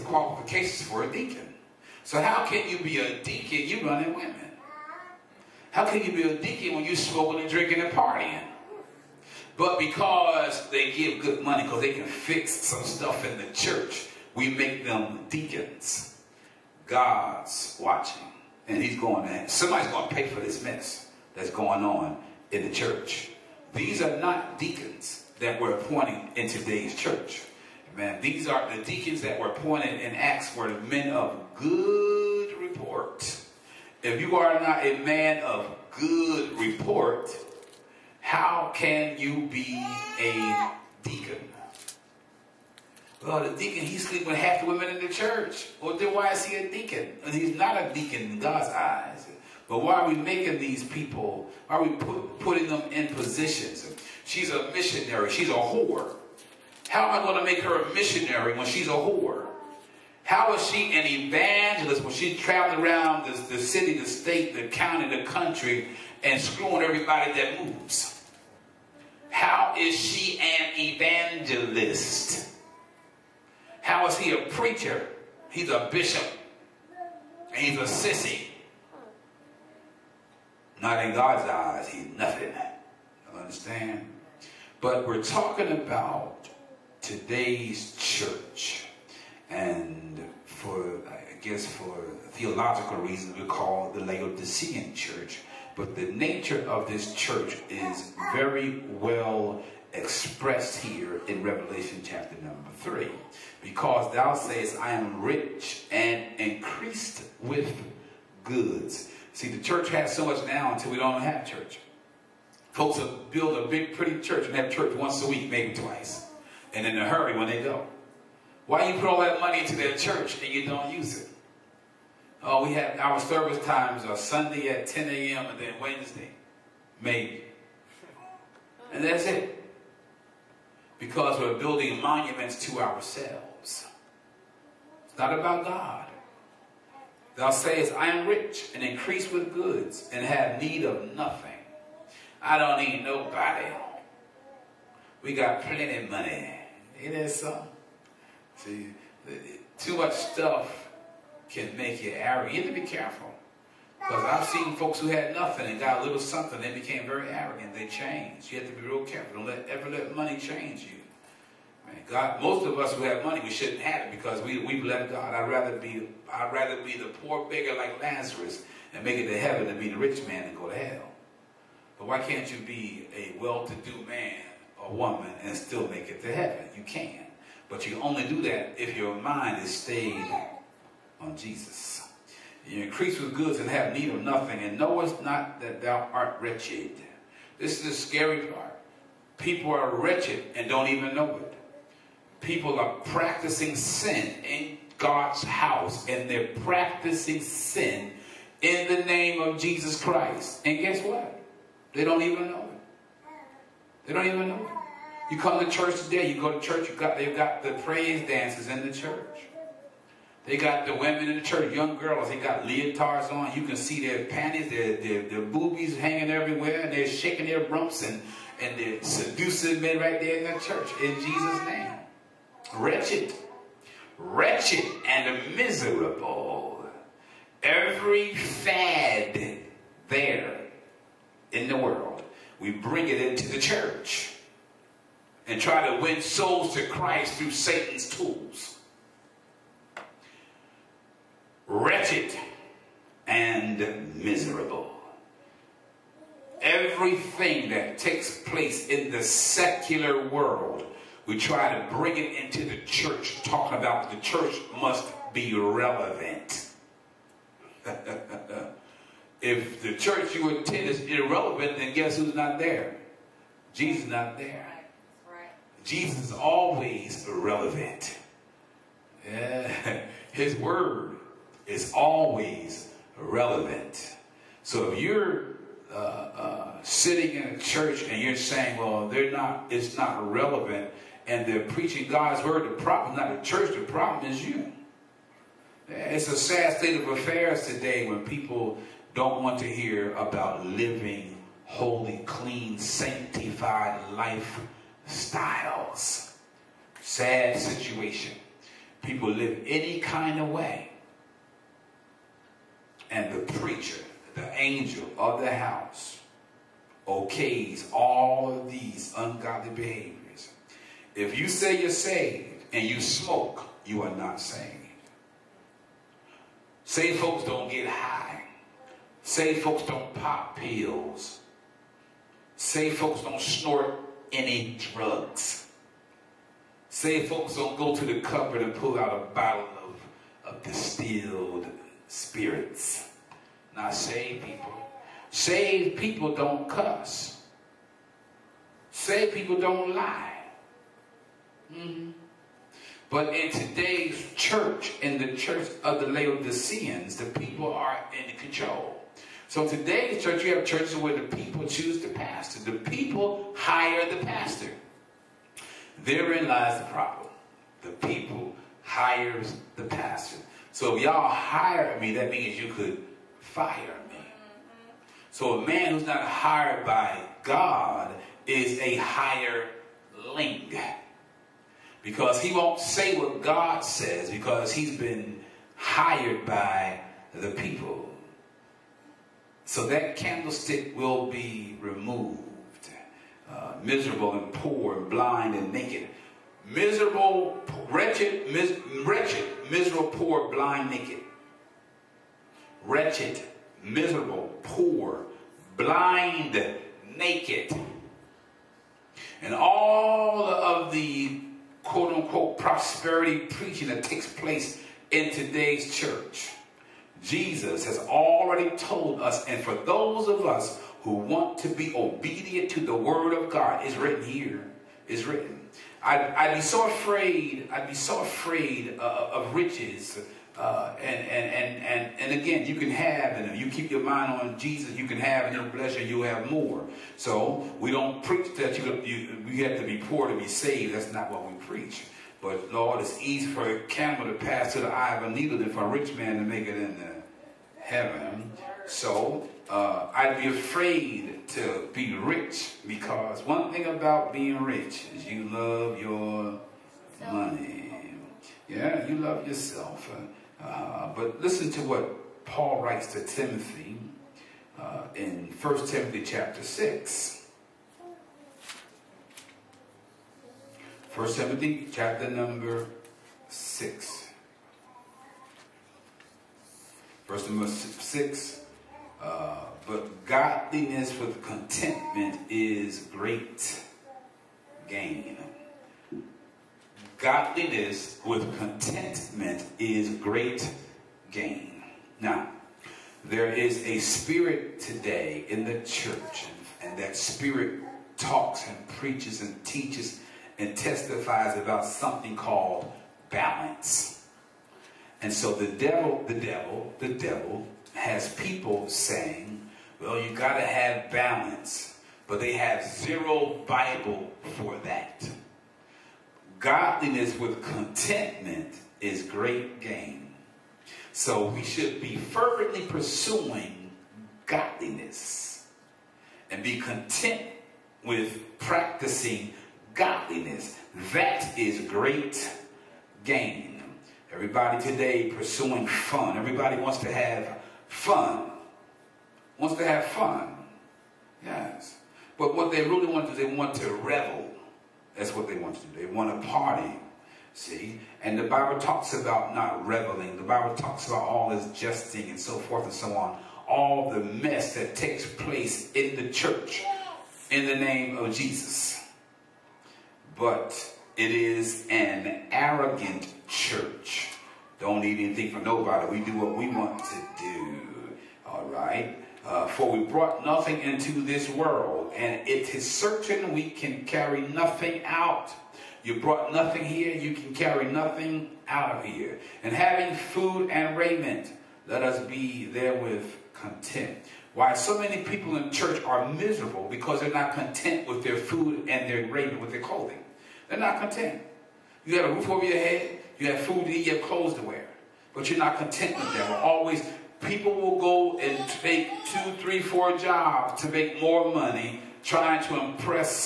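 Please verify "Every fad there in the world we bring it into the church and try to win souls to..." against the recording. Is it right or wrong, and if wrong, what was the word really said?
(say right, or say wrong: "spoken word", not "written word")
right.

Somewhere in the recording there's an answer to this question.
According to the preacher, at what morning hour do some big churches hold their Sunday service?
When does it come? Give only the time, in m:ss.
2:04.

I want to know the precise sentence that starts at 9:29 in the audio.
And having food and raiment, let us be therewith content.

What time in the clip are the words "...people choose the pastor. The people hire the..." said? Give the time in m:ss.
5:51.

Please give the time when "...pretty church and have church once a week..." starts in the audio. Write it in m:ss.
1:53.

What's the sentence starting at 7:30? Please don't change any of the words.
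Uh, but listen to what Paul writes to Timothy uh, in 1 Timothy chapter 6.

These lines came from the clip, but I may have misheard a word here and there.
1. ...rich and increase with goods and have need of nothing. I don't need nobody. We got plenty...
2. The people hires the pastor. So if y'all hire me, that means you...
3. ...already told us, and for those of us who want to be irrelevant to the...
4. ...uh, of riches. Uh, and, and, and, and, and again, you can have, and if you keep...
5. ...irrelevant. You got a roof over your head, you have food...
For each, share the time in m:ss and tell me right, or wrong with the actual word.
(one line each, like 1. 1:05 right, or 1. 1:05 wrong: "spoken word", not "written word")
1. 2:18 right
2. 5:57 right
3. 6:47 wrong: "obedient", not "irrelevant"
4. 6:59 right
5. 9:41 wrong: "content", not "irrelevant".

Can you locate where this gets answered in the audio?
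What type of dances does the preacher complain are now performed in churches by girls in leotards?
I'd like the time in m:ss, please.
3:27.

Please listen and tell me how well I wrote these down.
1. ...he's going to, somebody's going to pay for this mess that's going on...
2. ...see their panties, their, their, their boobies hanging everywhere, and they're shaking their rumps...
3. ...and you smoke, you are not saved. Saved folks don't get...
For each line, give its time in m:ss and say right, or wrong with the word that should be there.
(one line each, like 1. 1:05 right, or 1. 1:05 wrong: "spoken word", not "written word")
1. 0:18 right
2. 3:33 right
3. 5:12 right.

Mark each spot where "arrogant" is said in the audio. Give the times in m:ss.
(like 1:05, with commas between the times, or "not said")
2:32, 2:37, 9:12.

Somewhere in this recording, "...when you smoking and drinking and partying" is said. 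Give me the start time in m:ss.
0:06.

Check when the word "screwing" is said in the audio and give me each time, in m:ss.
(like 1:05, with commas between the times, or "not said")
1:06.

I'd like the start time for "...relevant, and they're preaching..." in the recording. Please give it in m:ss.
4:40.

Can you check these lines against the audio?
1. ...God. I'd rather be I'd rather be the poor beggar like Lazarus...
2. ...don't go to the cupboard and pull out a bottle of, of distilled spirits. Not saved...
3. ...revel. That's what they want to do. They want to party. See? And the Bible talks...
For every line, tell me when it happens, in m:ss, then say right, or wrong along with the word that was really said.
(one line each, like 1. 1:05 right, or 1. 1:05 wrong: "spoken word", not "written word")
1. 2:45 right
2. 5:27 right
3. 8:53 right.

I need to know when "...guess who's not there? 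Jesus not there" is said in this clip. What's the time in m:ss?
4:21.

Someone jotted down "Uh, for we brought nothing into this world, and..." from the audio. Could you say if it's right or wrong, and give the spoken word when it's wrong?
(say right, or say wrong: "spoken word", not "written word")
right.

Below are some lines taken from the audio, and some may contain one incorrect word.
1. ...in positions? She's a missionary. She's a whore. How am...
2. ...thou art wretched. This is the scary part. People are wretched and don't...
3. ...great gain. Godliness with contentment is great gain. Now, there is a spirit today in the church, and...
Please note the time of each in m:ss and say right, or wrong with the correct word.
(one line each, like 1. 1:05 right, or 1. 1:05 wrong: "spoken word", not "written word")
1. 0:52 right
2. 3:05 right
3. 7:53 right.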